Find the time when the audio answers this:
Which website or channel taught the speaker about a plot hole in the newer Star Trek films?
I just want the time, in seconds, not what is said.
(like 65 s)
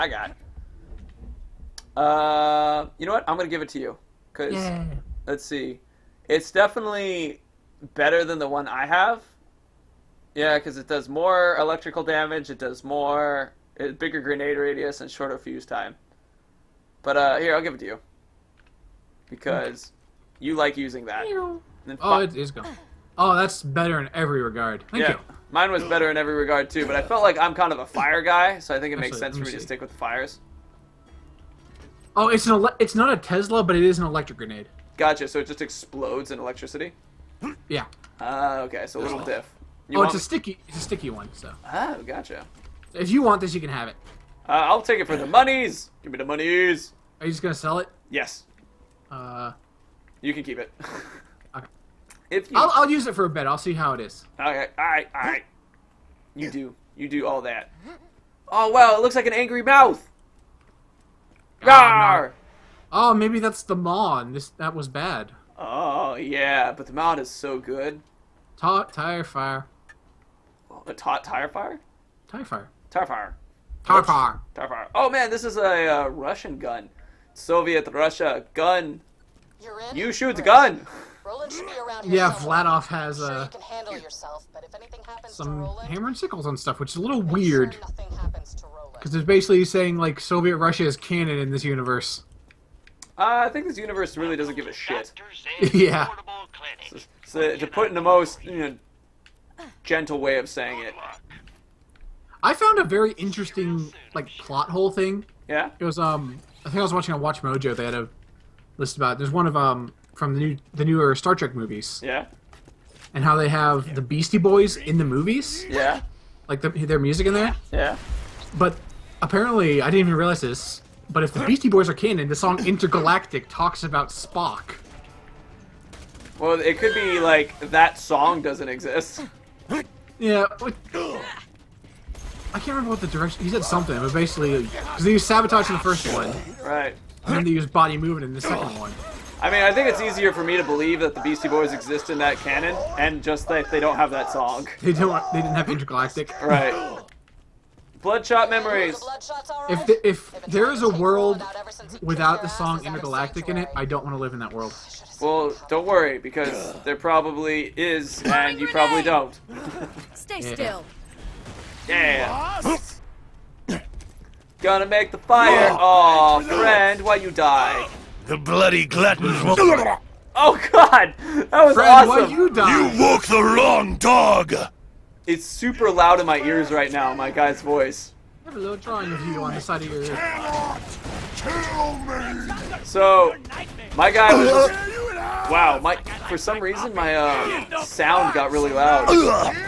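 107 s.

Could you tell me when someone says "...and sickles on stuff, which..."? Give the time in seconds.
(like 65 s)
86 s.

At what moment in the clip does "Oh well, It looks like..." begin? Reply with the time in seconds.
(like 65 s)
58 s.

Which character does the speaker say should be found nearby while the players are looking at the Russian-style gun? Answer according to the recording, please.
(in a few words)
Roland.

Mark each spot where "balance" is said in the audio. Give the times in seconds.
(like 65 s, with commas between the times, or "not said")
not said.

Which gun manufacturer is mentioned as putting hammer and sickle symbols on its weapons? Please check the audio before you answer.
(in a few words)
Vladoff.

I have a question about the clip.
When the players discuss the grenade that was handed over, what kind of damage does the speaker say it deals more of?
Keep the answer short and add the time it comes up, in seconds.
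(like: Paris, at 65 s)
Electrical damage, at 11 s.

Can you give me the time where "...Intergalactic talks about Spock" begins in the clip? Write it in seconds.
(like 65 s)
122 s.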